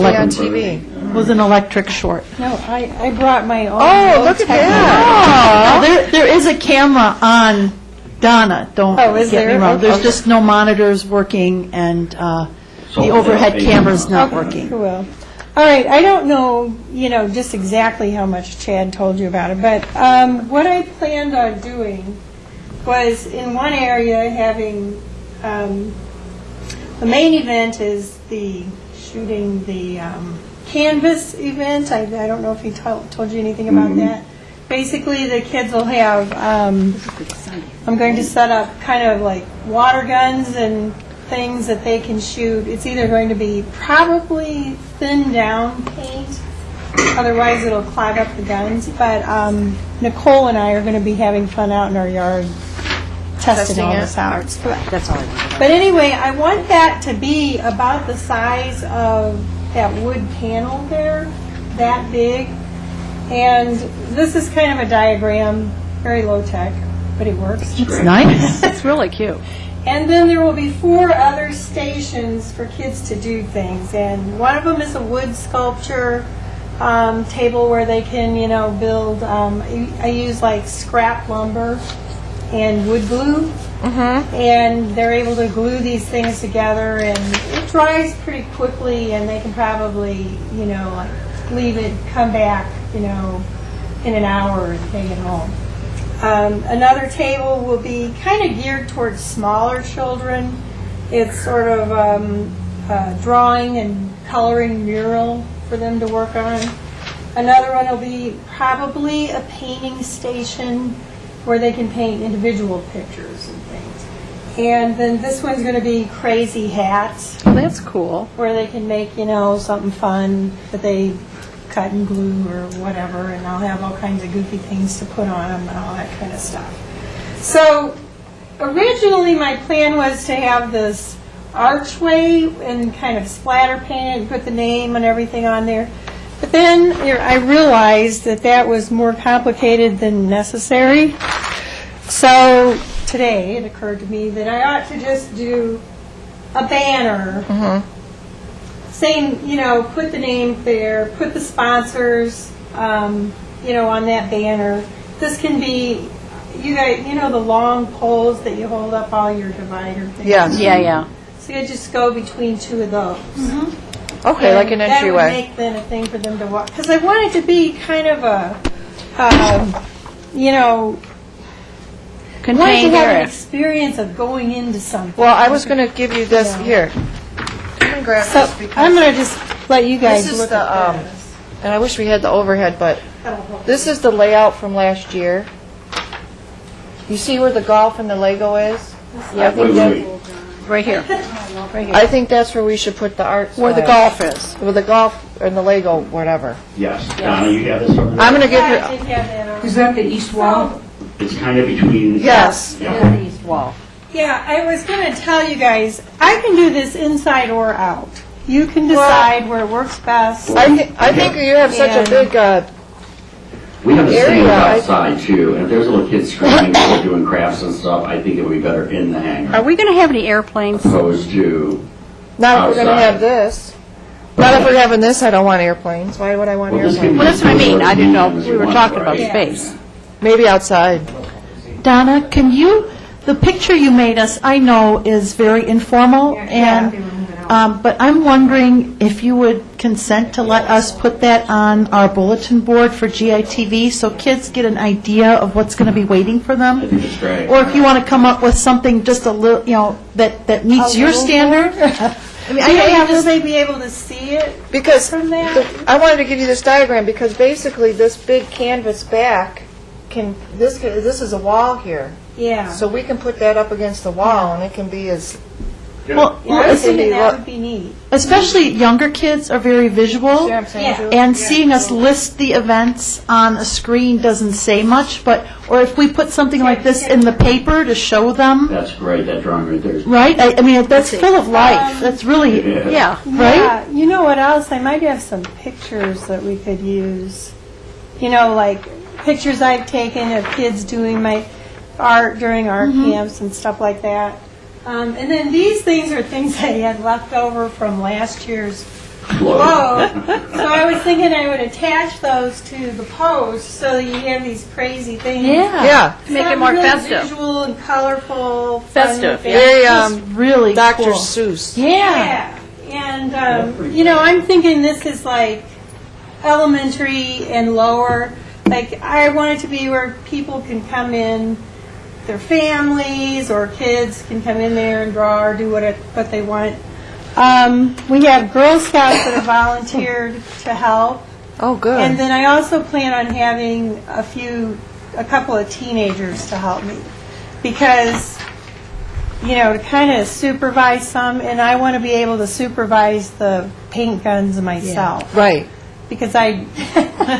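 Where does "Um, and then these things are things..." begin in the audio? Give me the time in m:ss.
4:54.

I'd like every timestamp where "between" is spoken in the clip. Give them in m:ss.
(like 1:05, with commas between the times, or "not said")
2:42, 3:21.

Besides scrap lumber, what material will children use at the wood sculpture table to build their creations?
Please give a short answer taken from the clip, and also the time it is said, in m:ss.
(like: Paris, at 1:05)
wood glue, at 1:22.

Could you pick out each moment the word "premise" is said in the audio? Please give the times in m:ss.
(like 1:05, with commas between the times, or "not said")
not said.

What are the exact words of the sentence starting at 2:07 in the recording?
So originally my plan was to have this archway and kind of splatter paint and put the name and everything on there.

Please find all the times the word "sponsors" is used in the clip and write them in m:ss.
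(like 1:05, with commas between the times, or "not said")
2:31.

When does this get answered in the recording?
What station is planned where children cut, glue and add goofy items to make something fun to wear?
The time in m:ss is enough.
1:56.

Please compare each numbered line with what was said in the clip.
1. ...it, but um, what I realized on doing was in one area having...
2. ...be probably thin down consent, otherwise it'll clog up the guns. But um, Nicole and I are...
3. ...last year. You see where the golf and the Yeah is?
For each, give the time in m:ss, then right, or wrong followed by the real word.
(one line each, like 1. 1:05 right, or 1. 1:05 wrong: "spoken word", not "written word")
1. 0:19 wrong: "planned", not "realized"
2. 0:43 wrong: "paint", not "consent"
3. 3:04 wrong: "Lego", not "Yeah".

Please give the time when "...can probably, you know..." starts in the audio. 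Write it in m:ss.
1:29.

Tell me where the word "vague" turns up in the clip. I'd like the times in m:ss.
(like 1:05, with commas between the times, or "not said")
not said.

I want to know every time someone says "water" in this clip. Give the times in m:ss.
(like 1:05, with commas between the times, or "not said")
0:39.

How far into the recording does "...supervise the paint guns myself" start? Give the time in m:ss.
5:42.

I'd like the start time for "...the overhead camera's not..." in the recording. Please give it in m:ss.
0:12.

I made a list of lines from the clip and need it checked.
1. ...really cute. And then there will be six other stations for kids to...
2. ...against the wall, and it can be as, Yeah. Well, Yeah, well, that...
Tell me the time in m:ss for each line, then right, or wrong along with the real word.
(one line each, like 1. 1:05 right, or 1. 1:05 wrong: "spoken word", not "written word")
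1. 1:08 wrong: "four", not "six"
2. 4:23 right.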